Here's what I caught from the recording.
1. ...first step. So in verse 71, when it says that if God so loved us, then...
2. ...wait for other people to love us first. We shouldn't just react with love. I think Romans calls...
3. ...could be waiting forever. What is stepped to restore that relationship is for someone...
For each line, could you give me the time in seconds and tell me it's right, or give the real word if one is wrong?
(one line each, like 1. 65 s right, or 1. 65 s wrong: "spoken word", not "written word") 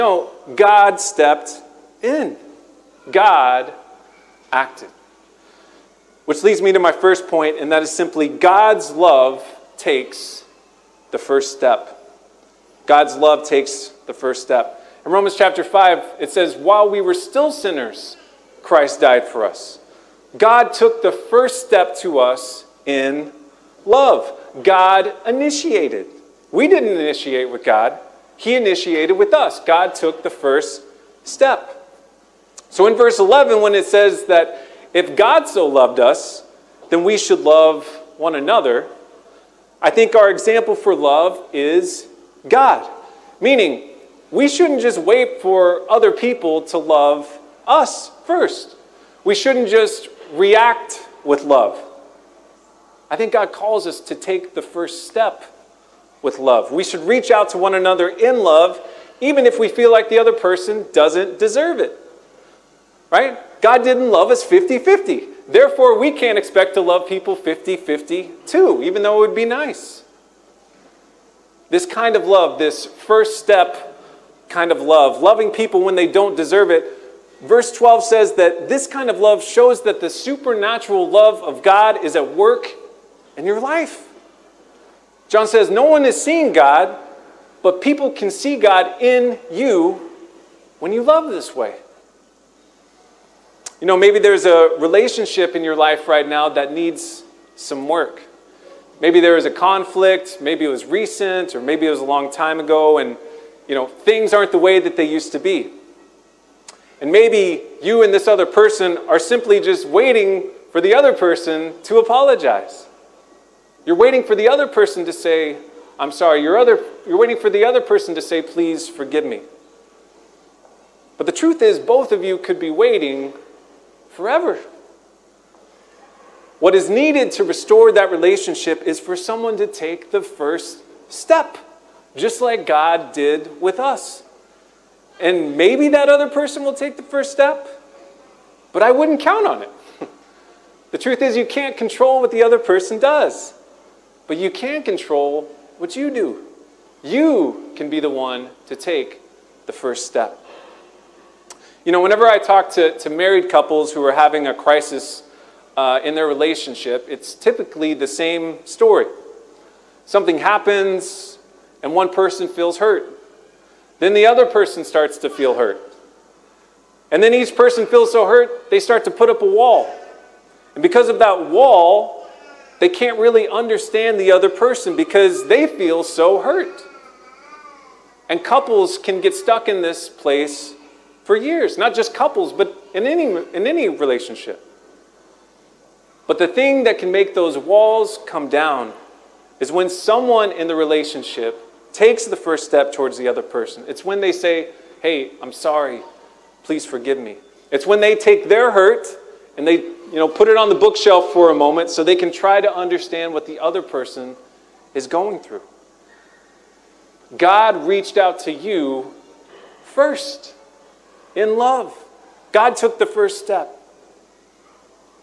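1. 30 s wrong: "11", not "71"
2. 44 s wrong: "God", not "Romans"
3. 122 s wrong: "needed", not "stepped".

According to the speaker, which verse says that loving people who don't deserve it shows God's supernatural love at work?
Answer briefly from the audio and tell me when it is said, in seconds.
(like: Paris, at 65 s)
Verse 12, at 77 s.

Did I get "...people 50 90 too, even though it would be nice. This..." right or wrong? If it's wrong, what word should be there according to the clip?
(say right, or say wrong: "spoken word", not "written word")
wrong: "50", not "90".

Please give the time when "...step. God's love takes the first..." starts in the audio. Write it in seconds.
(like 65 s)
11 s.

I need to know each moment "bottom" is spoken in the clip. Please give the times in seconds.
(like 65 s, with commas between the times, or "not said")
not said.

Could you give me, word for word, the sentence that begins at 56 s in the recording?
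We should reach out to one another in love, even if we feel like the other person doesn't deserve it.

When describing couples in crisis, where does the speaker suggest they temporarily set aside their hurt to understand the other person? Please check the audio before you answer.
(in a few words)
on the bookshelf.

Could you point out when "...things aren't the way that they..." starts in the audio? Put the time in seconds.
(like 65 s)
103 s.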